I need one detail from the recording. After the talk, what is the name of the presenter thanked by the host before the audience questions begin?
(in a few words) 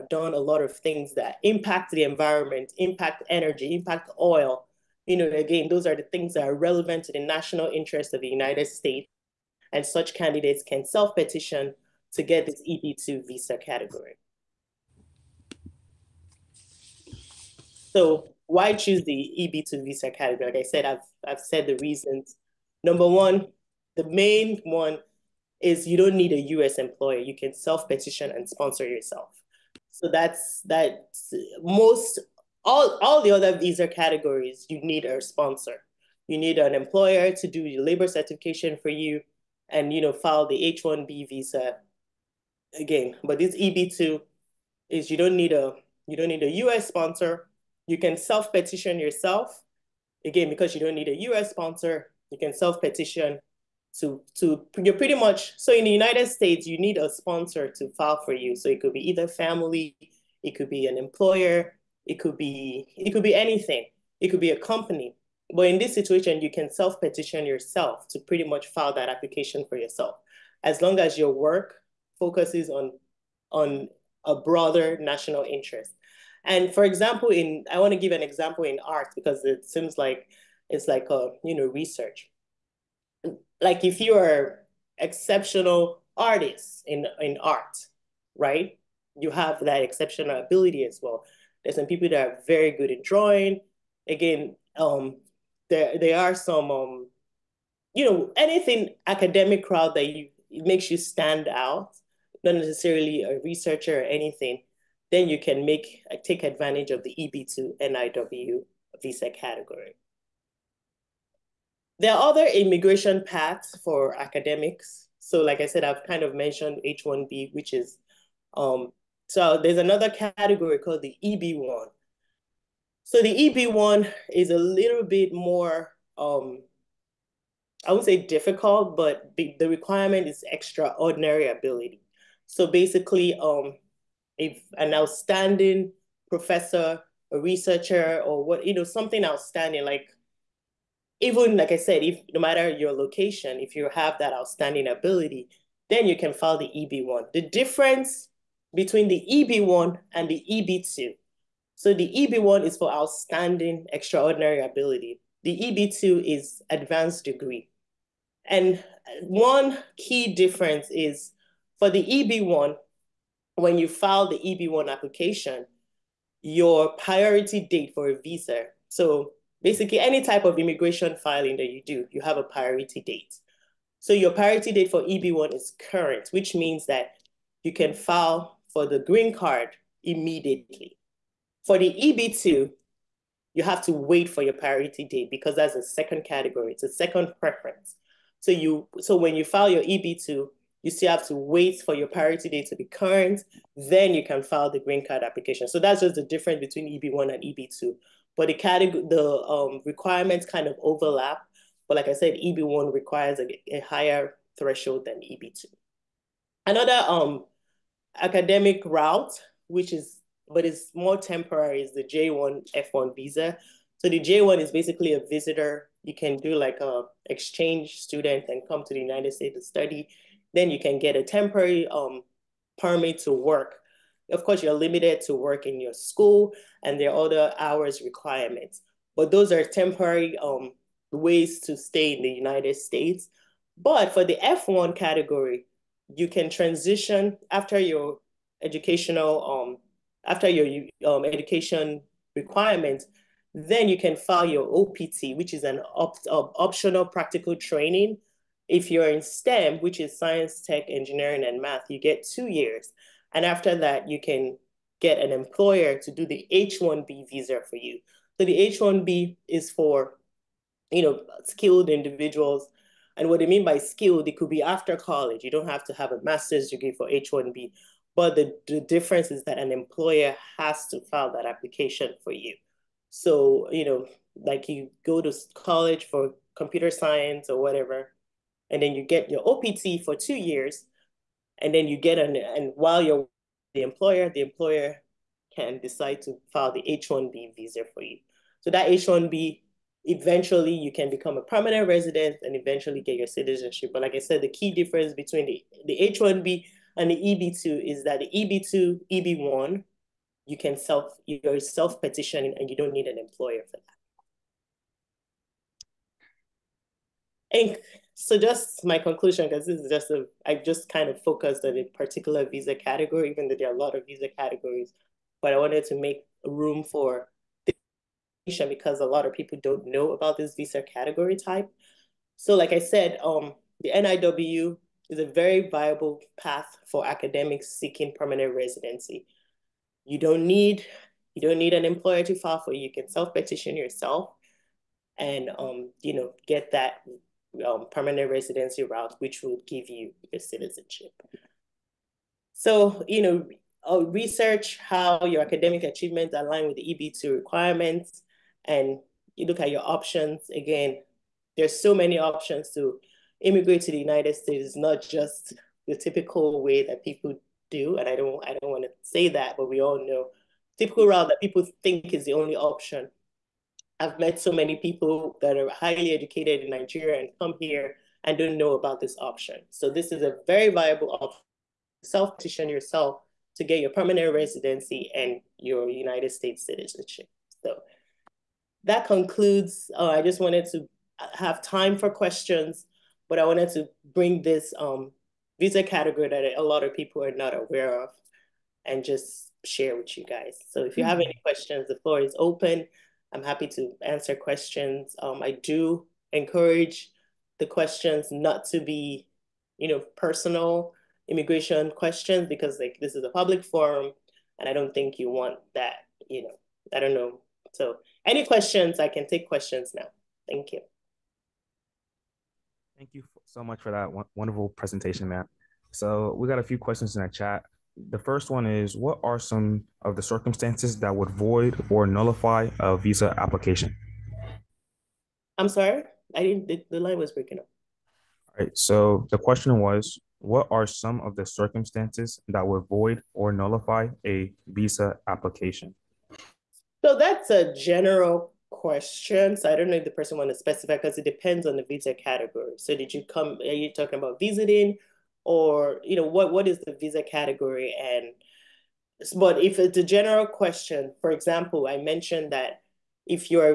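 Matt.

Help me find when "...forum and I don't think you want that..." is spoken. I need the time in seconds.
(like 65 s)
403 s.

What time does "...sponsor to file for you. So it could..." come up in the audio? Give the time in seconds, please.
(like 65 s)
57 s.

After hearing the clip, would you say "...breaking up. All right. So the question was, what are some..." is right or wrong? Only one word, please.
right.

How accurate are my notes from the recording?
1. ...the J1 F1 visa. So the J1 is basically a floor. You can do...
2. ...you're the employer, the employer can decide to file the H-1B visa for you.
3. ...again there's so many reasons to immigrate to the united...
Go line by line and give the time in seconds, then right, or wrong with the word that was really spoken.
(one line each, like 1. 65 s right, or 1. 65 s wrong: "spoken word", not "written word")
1. 211 s wrong: "visitor", not "floor"
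2. 283 s right
3. 350 s wrong: "options", not "reasons".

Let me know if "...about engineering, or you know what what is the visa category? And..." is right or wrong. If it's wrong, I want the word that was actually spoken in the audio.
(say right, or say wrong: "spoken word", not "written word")
wrong: "visiting", not "engineering".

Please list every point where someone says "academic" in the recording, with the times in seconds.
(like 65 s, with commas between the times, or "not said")
99 s, 114 s, 208 s, 327 s, 345 s.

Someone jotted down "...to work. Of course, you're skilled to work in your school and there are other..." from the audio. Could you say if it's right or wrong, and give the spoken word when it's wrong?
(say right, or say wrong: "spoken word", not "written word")
wrong: "limited", not "skilled".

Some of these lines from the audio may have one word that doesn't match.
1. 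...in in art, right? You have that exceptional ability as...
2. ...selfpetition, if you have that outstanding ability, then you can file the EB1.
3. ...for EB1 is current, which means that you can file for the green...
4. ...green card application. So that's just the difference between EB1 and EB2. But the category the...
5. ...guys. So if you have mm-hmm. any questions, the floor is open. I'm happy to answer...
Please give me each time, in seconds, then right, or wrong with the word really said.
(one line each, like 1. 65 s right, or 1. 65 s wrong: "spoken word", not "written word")
1. 86 s right
2. 142 s wrong: "location", not "selfpetition"
3. 174 s right
4. 194 s right
5. 390 s right.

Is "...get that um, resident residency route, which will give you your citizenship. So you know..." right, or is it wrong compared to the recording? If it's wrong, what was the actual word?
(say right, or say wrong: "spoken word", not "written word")
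wrong: "permanent", not "resident".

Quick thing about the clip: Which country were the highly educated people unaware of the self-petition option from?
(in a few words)
Nigeria.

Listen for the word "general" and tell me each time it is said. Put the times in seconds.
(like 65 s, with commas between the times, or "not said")
437 s, 450 s.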